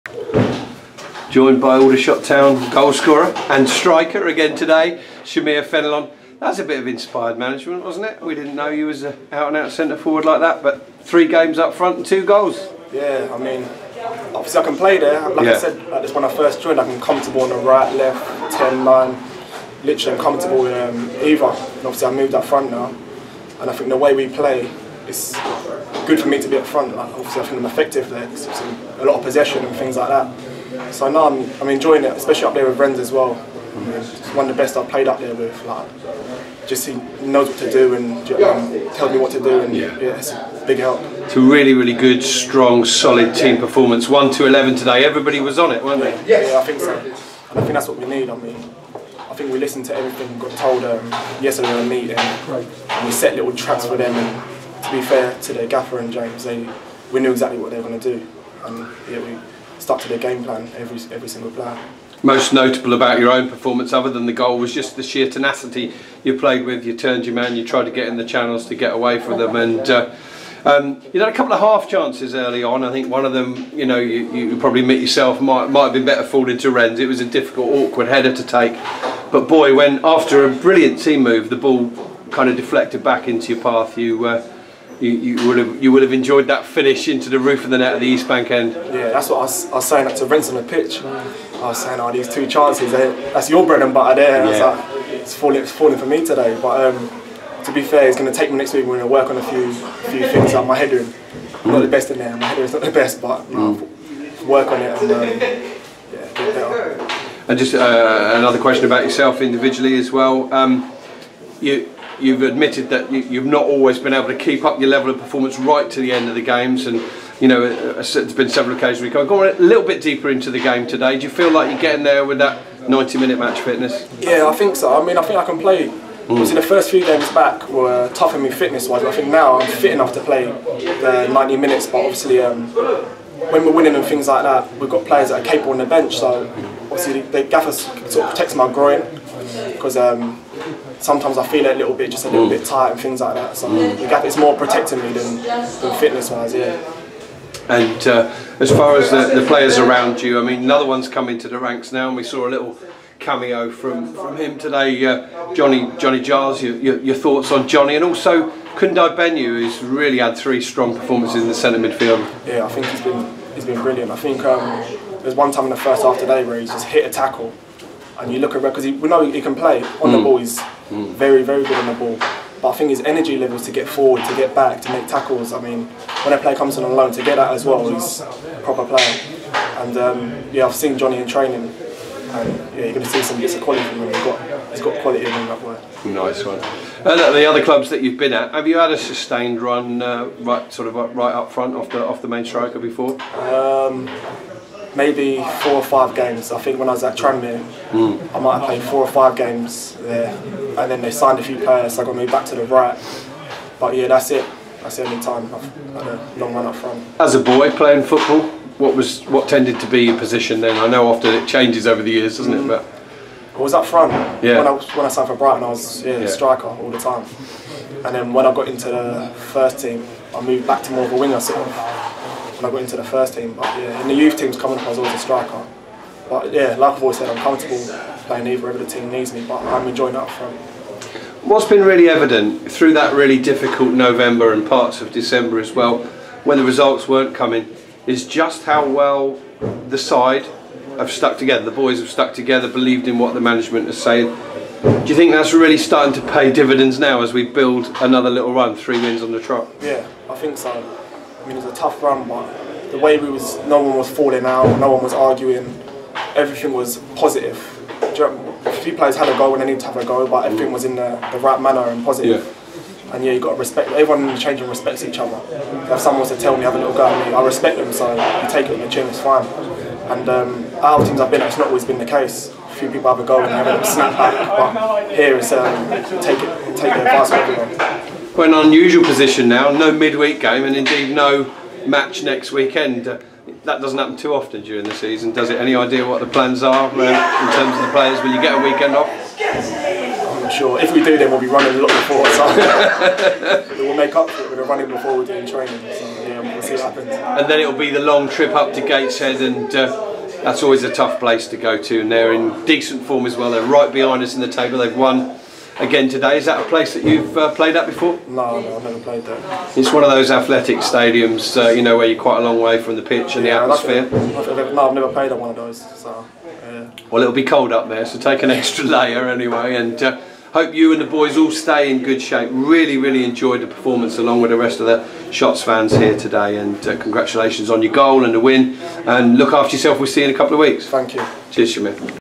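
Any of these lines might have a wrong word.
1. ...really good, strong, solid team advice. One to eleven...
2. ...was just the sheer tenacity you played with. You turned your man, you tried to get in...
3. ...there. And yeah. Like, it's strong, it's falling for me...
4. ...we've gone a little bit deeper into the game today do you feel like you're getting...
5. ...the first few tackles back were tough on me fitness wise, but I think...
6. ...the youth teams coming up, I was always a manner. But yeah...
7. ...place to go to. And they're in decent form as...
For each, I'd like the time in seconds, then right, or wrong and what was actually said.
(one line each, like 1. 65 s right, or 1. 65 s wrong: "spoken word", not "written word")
1. 41 s wrong: "performance", not "advice"
2. 64 s right
3. 94 s wrong: "falling", not "strong"
4. 119 s right
5. 126 s wrong: "games", not "tackles"
6. 224 s wrong: "striker", not "manner"
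7. 301 s right.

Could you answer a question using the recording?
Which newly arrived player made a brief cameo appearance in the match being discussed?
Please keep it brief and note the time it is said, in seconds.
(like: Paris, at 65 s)
Johnny Giles, at 155 s.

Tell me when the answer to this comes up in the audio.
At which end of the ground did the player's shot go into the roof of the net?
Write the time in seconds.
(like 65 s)
88 s.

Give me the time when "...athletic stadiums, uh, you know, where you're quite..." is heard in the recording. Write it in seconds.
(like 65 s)
310 s.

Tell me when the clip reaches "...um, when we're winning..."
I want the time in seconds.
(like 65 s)
132 s.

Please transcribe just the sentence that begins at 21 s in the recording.
And obviously I moved up front now, and I think the way we play, it's good for me to be up front.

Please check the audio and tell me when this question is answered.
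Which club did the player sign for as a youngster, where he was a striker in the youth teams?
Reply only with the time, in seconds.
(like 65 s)
215 s.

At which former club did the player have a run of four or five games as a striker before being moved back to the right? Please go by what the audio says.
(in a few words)
Tranmere.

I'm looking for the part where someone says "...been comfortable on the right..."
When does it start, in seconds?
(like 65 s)
16 s.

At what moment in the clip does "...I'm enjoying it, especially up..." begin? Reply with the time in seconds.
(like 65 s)
31 s.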